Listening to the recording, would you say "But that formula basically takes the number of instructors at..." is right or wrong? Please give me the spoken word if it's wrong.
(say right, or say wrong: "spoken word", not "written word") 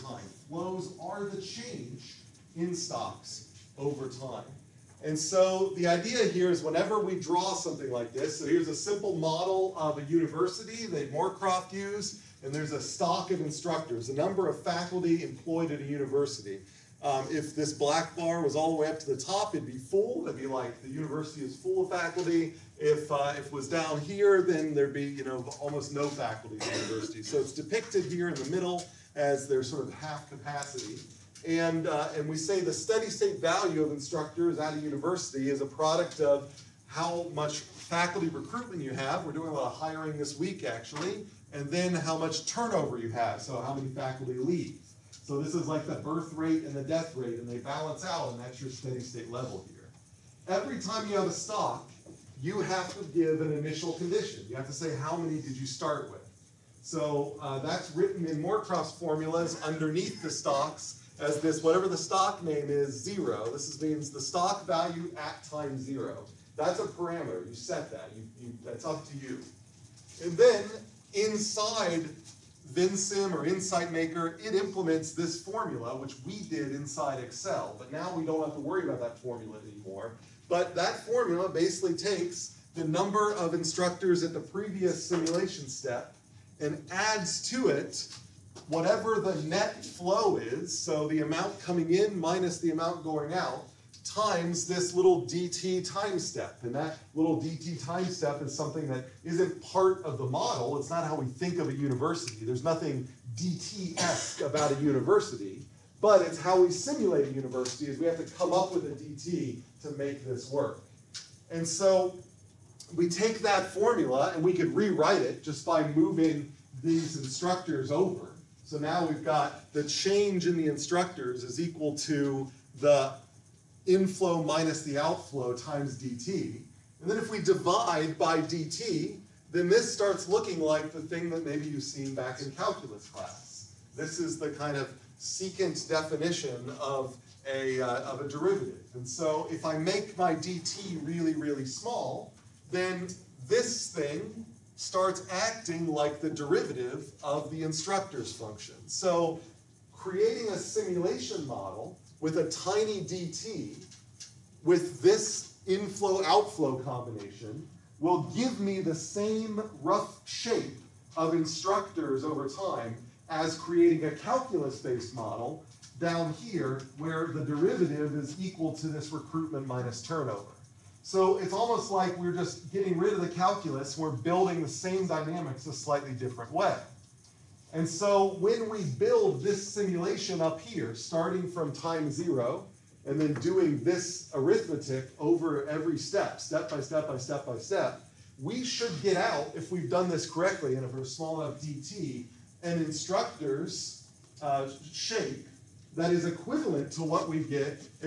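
right.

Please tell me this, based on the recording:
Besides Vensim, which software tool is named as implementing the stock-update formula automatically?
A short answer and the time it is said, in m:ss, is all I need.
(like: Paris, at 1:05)
Insight Maker, at 1:13.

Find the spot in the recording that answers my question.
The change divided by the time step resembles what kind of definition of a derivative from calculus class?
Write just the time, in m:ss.
2:15.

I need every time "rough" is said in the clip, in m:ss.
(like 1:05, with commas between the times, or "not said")
2:39.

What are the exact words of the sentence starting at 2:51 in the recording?
So it's almost like we're just getting rid of the calculus, we're building the same dynamics a slightly different way.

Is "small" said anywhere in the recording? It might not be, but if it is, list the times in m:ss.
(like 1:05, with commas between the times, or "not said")
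2:21, 3:11.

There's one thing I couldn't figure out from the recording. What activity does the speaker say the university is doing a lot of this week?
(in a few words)
Hiring.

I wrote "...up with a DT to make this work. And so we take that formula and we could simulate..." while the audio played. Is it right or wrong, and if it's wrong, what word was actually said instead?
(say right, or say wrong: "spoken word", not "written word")
wrong: "rewrite", not "simulate".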